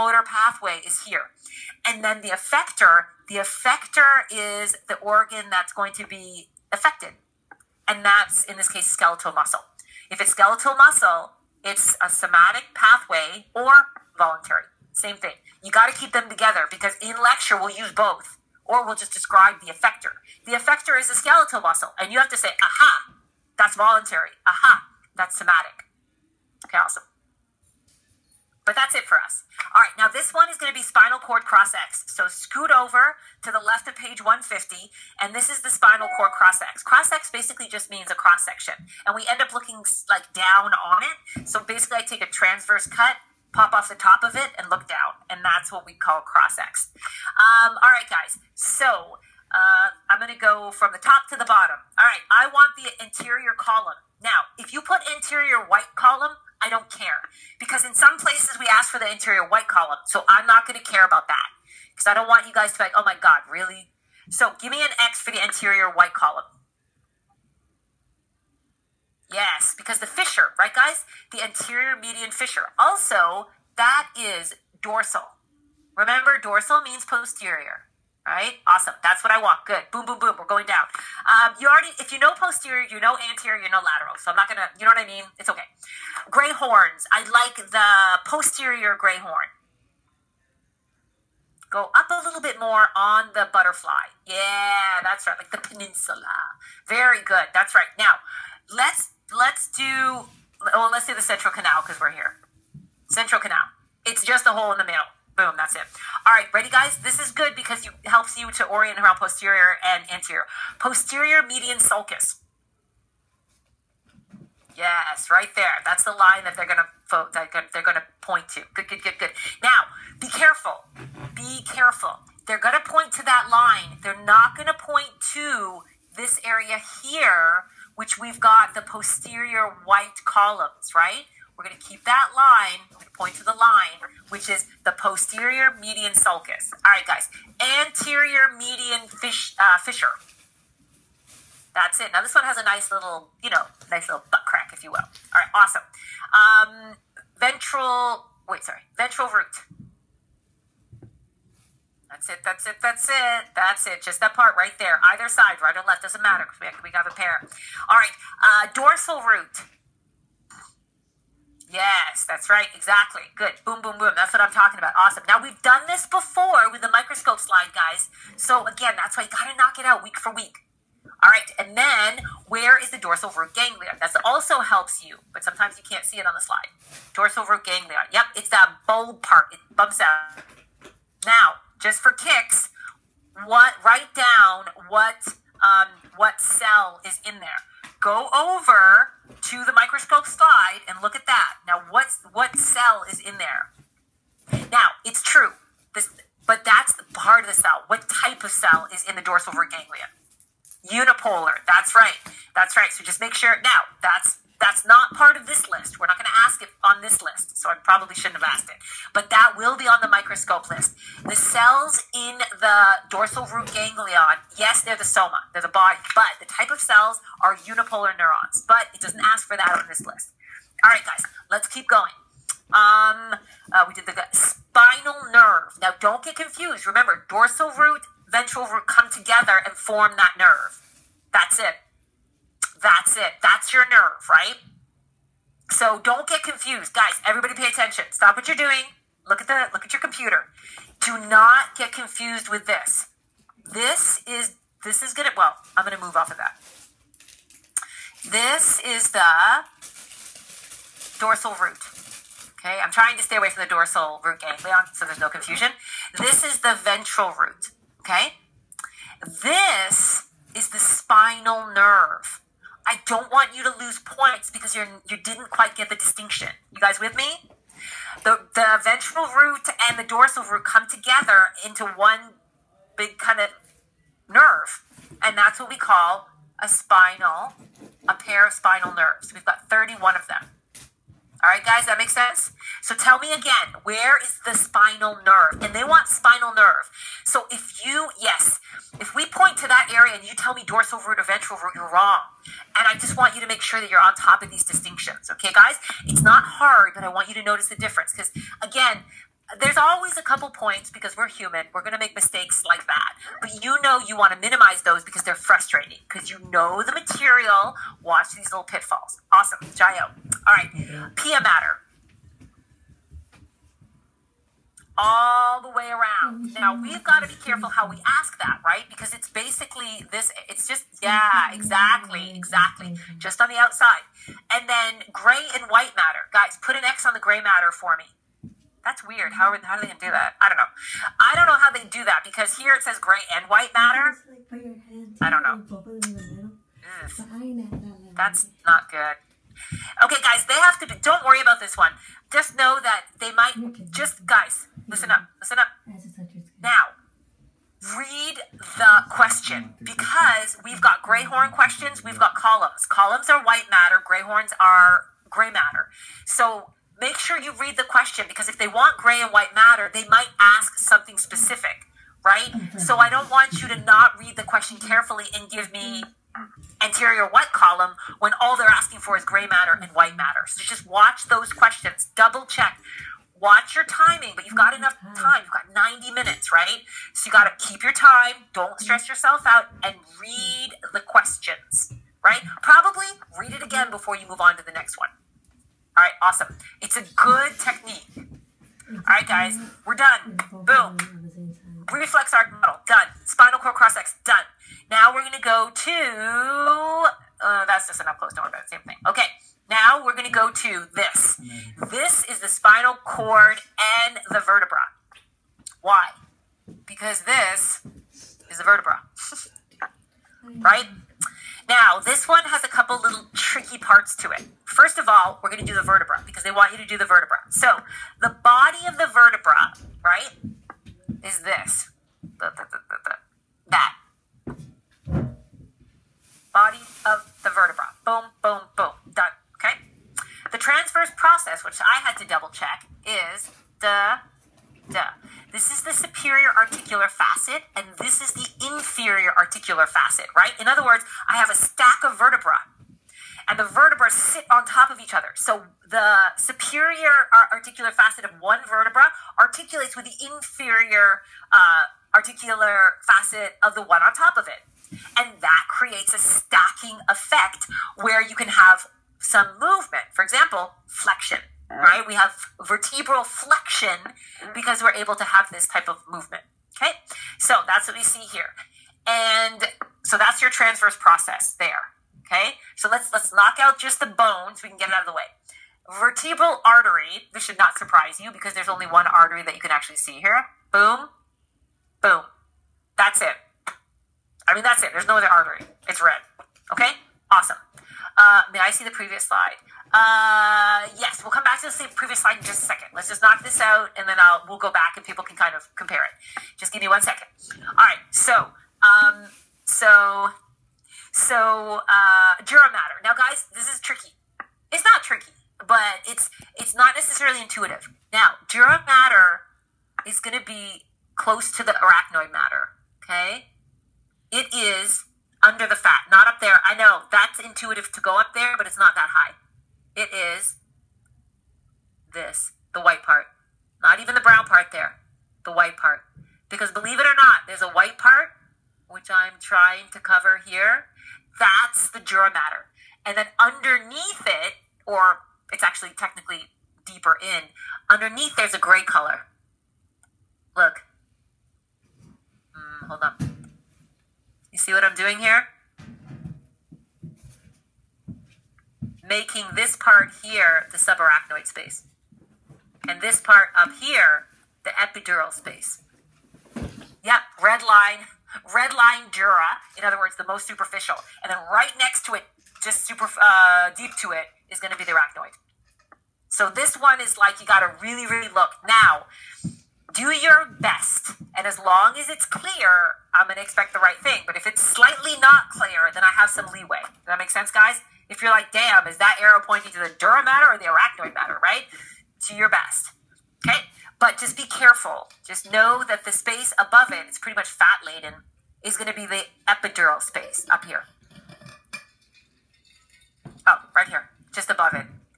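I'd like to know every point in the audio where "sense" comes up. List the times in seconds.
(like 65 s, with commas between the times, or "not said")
282 s, 577 s.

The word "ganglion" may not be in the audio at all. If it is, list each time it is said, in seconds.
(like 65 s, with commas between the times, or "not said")
173 s, 177 s, 199 s, 213 s, 254 s.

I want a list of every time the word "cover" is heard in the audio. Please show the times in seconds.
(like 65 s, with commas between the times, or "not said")
529 s.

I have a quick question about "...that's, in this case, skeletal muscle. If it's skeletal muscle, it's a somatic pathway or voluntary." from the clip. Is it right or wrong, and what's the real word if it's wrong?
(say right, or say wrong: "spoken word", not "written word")
right.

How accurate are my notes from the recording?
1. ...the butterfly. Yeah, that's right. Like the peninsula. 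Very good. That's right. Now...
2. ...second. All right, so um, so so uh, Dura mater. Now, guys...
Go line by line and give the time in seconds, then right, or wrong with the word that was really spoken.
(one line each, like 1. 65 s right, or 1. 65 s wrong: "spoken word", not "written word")
1. 93 s right
2. 497 s right.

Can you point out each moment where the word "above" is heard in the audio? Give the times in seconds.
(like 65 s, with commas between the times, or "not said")
586 s, 594 s.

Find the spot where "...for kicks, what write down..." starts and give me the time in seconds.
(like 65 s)
181 s.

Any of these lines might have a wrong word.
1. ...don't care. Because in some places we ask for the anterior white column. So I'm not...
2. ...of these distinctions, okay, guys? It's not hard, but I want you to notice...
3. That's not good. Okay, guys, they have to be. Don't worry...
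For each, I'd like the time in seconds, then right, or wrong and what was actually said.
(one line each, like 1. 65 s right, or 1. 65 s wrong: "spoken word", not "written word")
1. 56 s right
2. 294 s right
3. 338 s right.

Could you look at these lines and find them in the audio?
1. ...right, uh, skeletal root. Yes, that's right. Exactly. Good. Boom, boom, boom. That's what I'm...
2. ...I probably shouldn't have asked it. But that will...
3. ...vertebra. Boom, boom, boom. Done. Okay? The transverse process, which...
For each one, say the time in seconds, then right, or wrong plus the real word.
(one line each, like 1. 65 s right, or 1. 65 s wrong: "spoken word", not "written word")
1. 157 s wrong: "dorsal", not "skeletal"
2. 207 s right
3. 427 s right.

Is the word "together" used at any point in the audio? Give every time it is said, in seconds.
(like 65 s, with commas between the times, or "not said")
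16 s, 229 s, 270 s.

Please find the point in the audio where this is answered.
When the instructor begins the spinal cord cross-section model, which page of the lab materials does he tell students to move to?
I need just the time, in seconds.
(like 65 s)
33 s.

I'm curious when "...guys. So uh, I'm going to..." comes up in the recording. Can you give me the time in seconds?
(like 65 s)
48 s.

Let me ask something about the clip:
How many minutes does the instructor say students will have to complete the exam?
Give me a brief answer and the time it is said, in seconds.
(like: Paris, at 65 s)
90, at 375 s.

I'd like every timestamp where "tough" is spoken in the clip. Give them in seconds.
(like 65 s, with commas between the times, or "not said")
not said.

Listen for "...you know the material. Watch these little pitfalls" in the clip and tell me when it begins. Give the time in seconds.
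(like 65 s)
306 s.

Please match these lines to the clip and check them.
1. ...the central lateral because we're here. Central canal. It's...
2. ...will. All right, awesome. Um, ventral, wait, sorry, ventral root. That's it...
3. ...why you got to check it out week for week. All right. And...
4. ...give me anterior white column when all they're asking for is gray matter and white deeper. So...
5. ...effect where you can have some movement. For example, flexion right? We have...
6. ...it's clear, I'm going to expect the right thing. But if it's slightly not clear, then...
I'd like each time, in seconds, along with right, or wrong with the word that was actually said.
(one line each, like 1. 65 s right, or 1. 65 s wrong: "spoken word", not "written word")
1. 101 s wrong: "canal", not "lateral"
2. 144 s right
3. 169 s wrong: "knock", not "check"
4. 365 s wrong: "matter", not "deeper"
5. 457 s right
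6. 572 s right.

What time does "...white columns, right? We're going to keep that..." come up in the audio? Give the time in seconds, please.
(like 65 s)
129 s.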